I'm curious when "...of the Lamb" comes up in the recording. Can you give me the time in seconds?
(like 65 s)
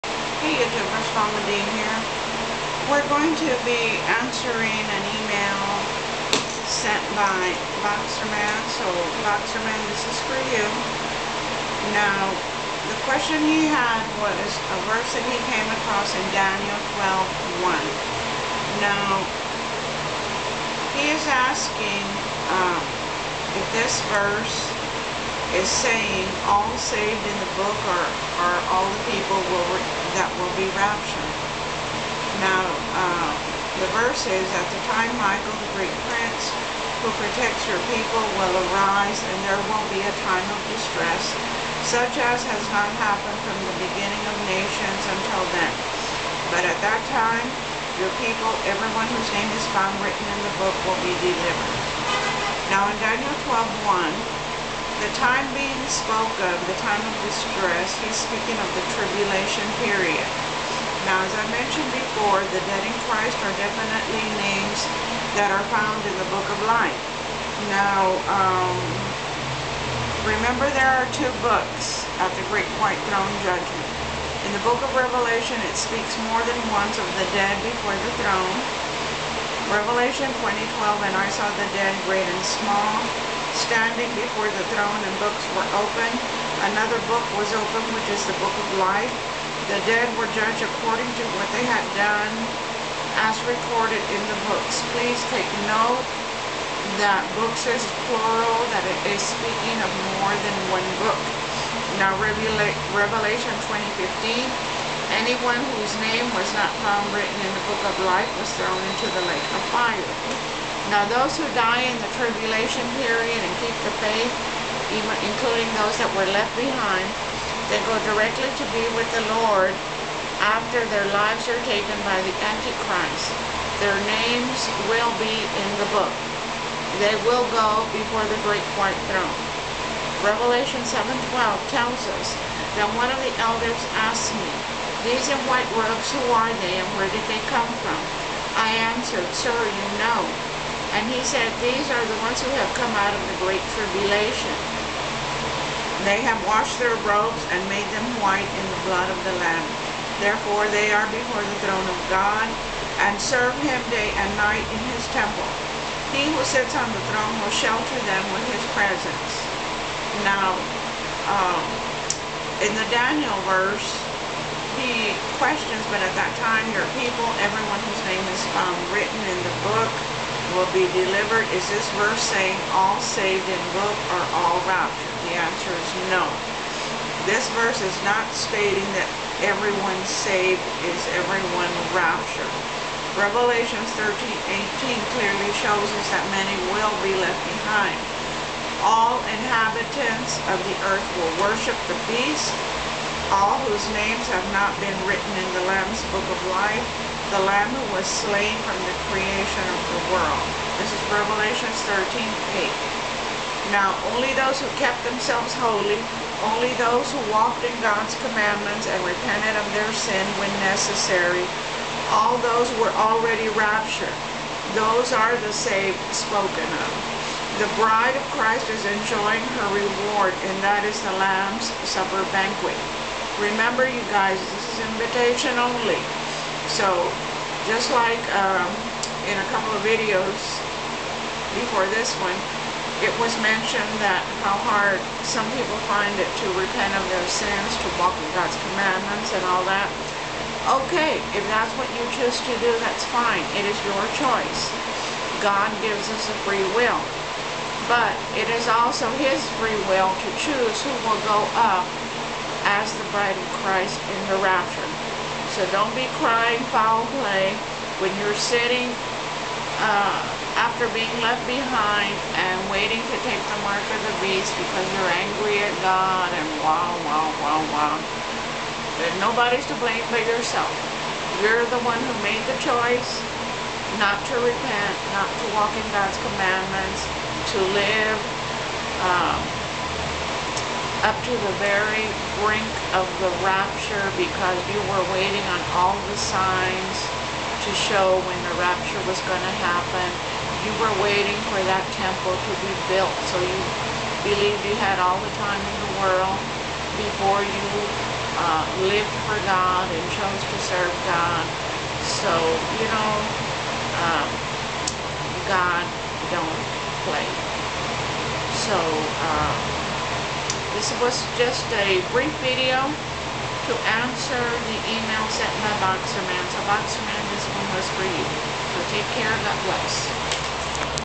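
149 s.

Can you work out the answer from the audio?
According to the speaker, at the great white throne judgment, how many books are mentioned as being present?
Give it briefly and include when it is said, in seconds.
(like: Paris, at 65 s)
2, at 71 s.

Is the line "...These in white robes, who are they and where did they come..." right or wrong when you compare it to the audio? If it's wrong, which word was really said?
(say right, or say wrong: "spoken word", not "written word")
right.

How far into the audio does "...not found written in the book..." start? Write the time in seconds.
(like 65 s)
106 s.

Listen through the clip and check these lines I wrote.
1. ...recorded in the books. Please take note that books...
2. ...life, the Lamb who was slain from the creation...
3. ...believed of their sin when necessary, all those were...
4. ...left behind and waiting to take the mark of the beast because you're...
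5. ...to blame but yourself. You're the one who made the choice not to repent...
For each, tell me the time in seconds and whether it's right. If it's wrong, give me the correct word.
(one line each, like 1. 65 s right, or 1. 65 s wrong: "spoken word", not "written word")
1. 93 s right
2. 196 s right
3. 208 s wrong: "repented", not "believed"
4. 261 s right
5. 269 s right.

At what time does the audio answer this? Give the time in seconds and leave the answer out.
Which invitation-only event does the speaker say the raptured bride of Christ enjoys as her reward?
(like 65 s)
221 s.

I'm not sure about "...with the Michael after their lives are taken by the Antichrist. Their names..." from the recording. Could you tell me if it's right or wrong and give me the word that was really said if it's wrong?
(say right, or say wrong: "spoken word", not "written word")
wrong: "Lord", not "Michael".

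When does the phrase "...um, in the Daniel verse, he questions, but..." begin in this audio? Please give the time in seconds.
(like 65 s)
161 s.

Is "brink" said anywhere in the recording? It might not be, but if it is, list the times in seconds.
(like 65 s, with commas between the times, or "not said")
282 s.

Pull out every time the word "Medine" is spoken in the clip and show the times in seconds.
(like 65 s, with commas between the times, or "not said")
1 s.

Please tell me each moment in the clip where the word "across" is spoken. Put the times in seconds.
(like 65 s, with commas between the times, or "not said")
15 s.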